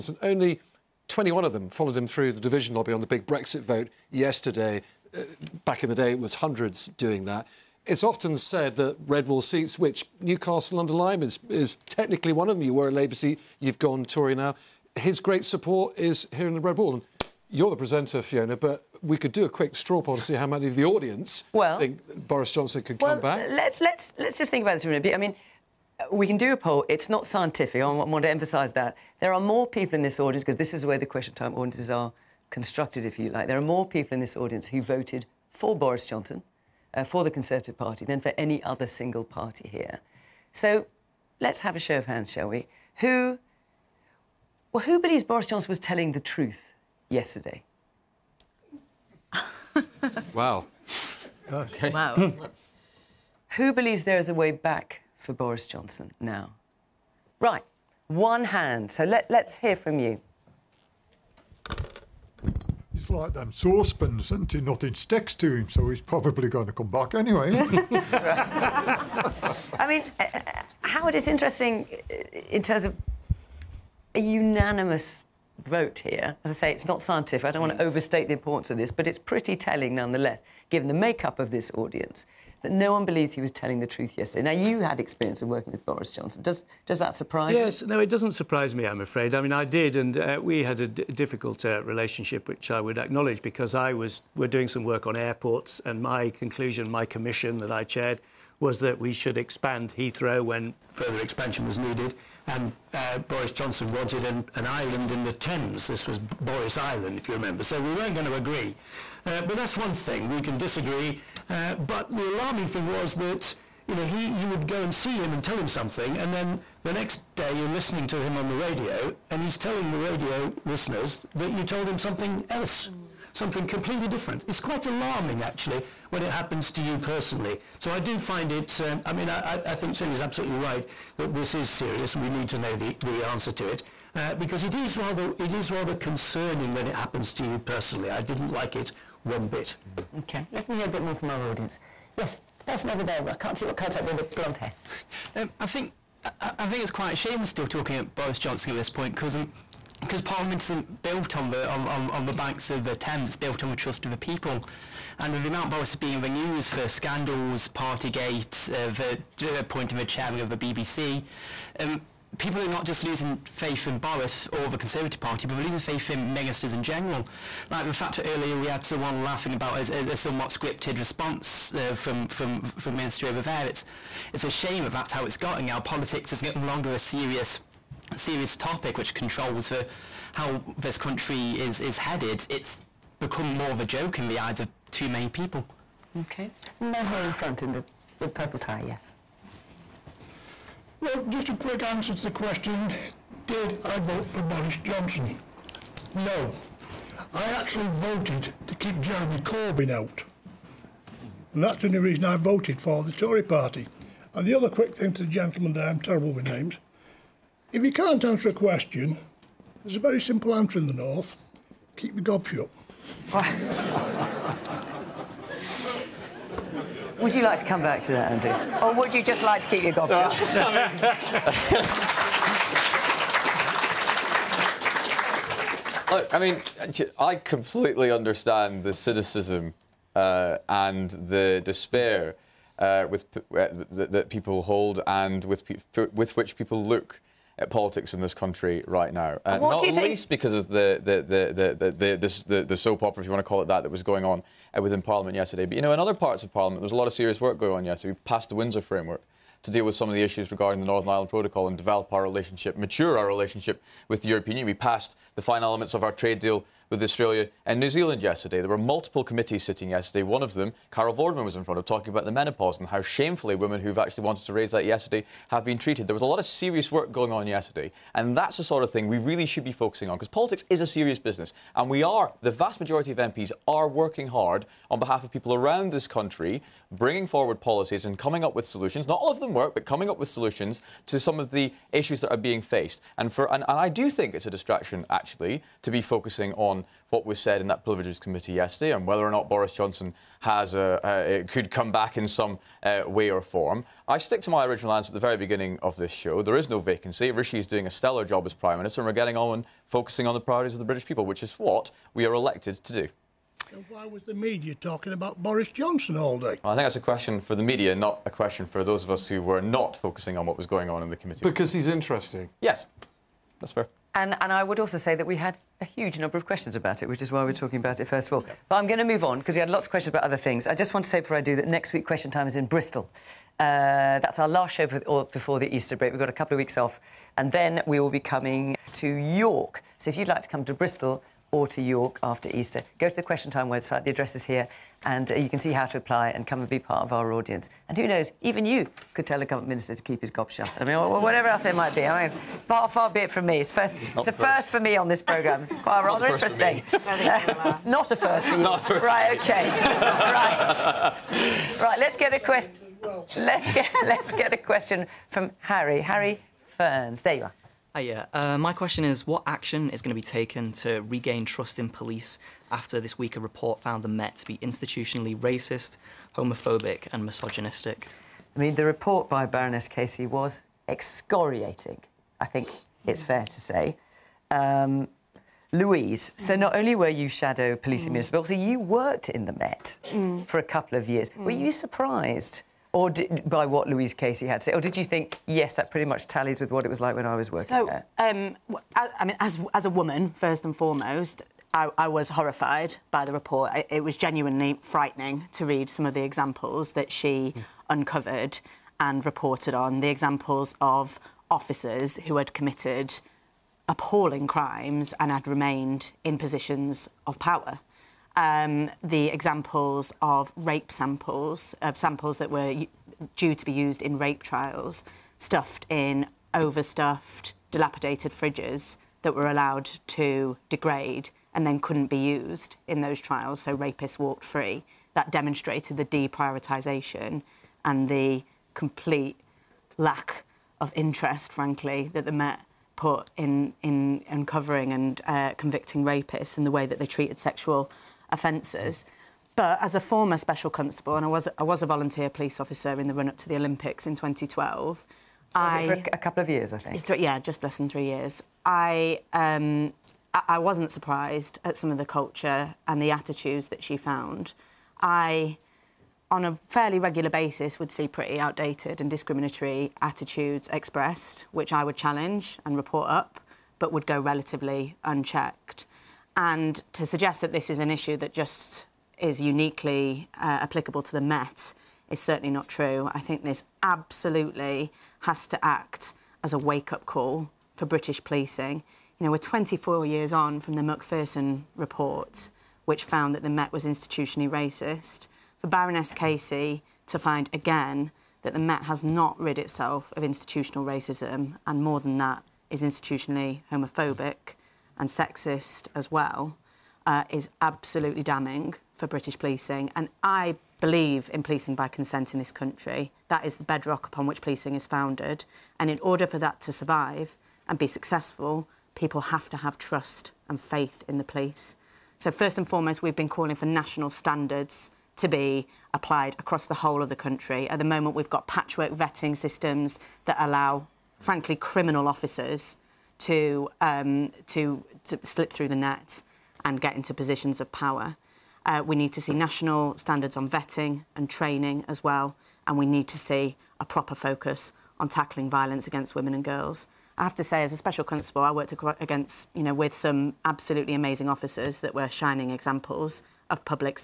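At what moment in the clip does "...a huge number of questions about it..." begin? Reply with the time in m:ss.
5:15.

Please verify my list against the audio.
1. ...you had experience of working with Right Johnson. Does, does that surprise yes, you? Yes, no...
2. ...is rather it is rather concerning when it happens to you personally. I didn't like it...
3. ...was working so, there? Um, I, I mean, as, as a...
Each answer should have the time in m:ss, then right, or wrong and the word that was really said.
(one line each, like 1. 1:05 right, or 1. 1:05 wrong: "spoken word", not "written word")
1. 1:24 wrong: "Boris", not "Right"
2. 2:14 right
3. 6:27 right.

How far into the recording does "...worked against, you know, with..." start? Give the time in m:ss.
8:58.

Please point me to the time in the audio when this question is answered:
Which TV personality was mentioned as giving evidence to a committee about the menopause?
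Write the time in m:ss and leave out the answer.
4:20.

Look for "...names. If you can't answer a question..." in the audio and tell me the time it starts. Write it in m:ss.
3:26.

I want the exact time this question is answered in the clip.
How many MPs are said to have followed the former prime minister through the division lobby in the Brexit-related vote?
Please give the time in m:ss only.
0:01.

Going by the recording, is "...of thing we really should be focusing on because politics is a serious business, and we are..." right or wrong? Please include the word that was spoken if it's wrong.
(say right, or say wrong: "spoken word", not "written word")
right.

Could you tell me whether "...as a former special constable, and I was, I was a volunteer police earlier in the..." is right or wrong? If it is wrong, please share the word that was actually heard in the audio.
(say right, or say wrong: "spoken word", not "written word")
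wrong: "officer", not "earlier".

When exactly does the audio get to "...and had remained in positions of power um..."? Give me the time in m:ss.
6:45.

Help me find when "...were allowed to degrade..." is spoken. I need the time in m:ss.
6:59.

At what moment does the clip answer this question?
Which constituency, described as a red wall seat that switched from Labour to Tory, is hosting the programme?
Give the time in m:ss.
0:10.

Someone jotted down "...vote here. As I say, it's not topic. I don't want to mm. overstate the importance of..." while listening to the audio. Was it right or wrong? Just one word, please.
wrong.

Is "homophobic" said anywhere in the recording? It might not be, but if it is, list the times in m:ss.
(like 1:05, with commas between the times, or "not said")
6:06, 8:13.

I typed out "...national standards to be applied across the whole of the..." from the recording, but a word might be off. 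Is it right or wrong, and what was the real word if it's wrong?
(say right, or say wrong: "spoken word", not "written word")
right.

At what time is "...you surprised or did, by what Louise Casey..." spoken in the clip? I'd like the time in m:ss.
6:21.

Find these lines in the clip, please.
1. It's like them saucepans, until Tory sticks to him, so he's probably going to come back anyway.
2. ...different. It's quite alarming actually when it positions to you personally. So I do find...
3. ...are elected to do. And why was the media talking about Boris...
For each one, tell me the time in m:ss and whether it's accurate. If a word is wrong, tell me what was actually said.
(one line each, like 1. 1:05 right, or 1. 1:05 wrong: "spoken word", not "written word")
1. 1:03 wrong: "Nothing", not "Tory"
2. 2:04 wrong: "happens", not "positions"
3. 5:02 right.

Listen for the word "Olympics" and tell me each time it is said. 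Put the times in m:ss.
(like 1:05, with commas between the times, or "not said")
7:23.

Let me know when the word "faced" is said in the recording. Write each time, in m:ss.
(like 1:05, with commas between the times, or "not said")
4:42.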